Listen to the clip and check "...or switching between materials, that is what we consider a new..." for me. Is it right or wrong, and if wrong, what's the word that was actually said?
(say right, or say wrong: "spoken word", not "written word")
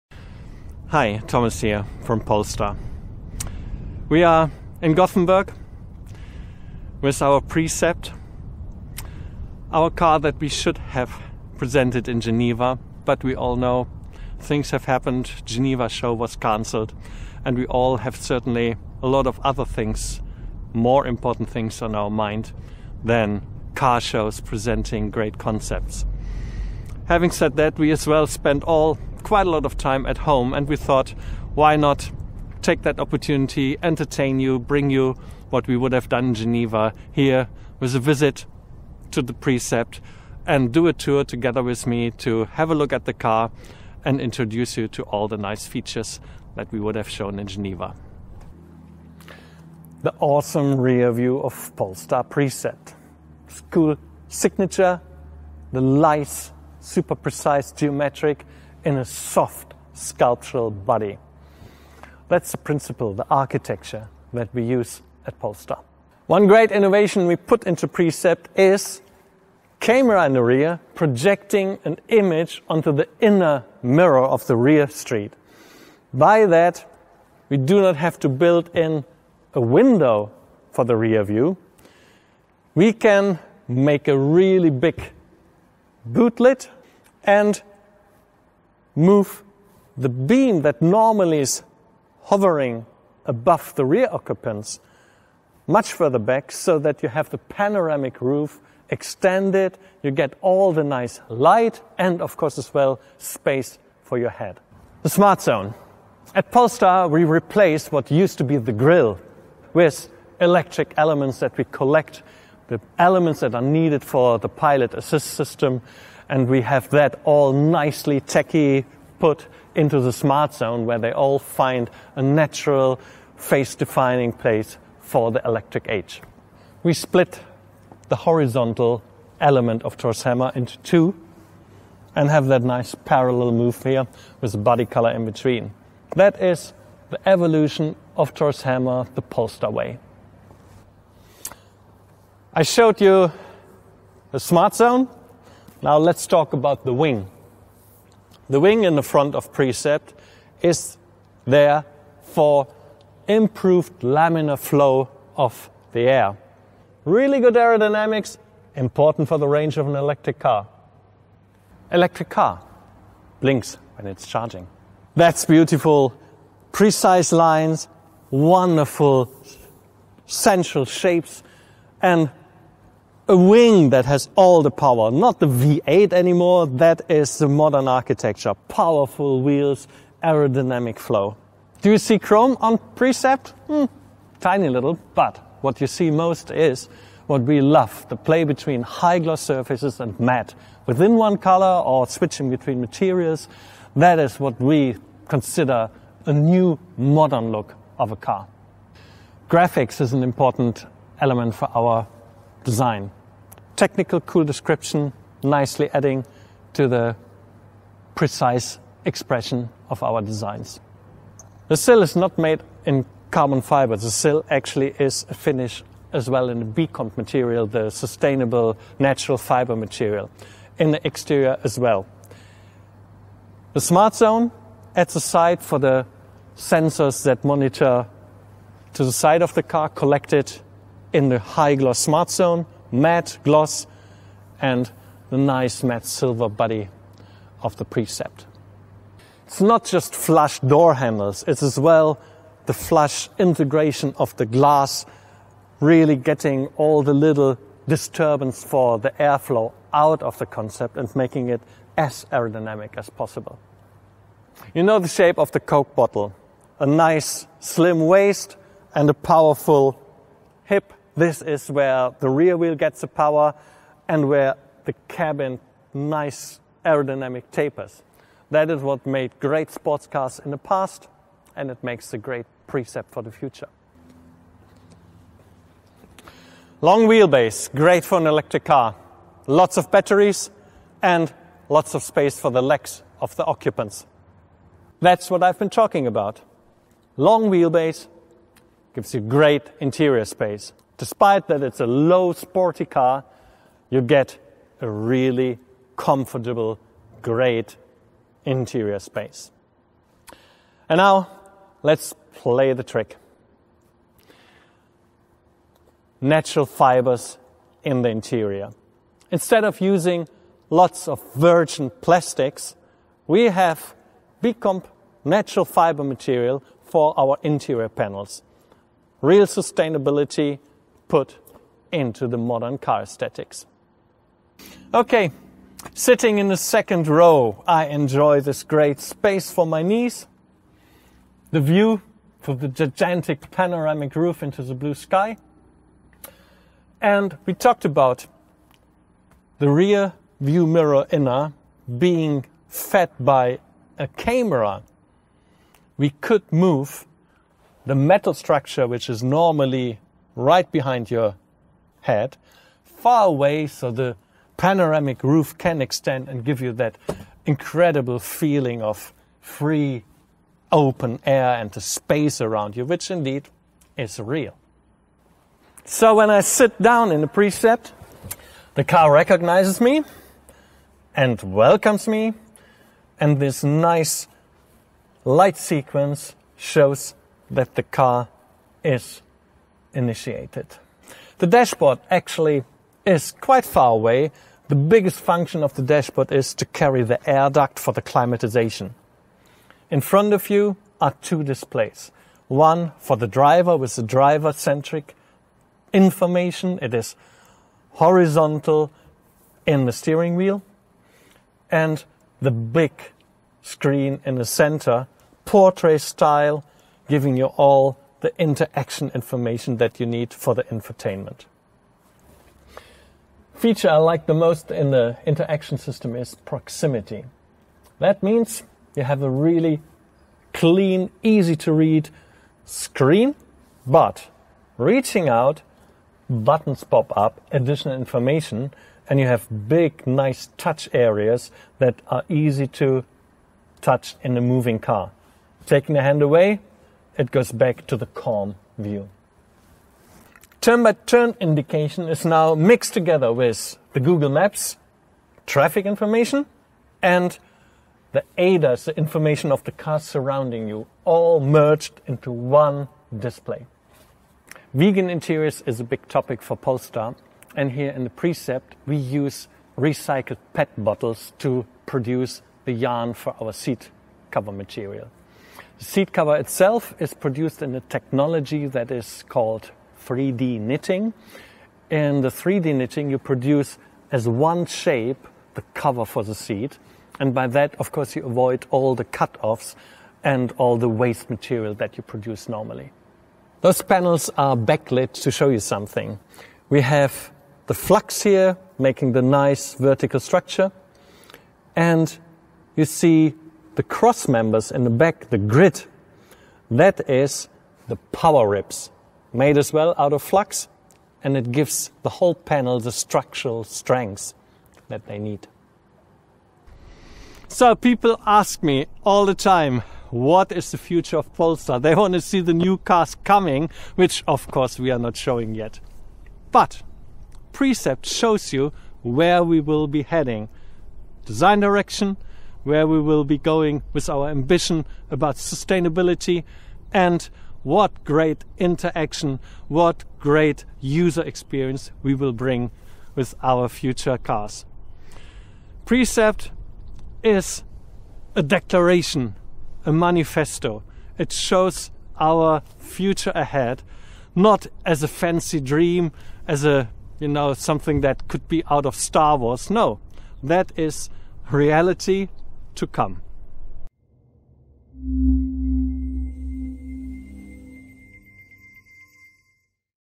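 right.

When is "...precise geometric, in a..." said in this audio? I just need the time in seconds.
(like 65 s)
57 s.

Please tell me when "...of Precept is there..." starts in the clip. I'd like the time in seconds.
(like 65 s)
149 s.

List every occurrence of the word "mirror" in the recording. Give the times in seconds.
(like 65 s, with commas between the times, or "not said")
73 s, 340 s.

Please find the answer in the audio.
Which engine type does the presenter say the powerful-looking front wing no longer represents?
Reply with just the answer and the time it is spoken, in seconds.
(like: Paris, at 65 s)
V8, at 175 s.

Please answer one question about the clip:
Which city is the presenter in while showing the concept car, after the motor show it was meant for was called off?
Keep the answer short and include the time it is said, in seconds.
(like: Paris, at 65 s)
Gothenburg, at 4 s.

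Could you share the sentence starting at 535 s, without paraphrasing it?
Precept is a declaration, a manifesto.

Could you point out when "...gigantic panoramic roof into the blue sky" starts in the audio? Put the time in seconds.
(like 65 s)
332 s.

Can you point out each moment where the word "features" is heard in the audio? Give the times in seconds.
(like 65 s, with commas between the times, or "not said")
45 s, 413 s.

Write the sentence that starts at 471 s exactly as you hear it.
In the 3D knitting, you produce as one shape the cover for the seat.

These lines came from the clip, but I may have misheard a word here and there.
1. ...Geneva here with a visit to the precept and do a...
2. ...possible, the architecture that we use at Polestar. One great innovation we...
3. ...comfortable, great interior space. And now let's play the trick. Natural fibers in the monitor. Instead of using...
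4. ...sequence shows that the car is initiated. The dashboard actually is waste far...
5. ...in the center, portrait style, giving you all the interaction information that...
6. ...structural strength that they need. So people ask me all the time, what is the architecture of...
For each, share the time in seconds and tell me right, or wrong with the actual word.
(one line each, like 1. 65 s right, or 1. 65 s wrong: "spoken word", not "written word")
1. 36 s right
2. 62 s wrong: "principle", not "possible"
3. 295 s wrong: "interior", not "monitor"
4. 375 s wrong: "quite", not "waste"
5. 404 s right
6. 502 s wrong: "future", not "architecture".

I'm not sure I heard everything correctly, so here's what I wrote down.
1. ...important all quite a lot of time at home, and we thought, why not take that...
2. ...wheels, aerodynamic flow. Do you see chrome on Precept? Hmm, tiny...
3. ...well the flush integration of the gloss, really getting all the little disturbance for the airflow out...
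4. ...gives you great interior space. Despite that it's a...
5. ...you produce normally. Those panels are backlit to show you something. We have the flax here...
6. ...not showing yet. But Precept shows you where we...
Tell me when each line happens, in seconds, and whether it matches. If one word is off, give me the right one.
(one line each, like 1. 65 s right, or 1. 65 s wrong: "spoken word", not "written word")
1. 28 s wrong: "spent", not "important"
2. 179 s right
3. 241 s wrong: "glass", not "gloss"
4. 288 s right
5. 481 s right
6. 514 s right.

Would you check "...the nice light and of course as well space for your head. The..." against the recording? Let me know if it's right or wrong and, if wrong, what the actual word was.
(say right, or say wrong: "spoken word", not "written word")
right.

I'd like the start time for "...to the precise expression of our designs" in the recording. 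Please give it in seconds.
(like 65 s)
206 s.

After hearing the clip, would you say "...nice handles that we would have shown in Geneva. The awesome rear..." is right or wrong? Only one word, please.
wrong.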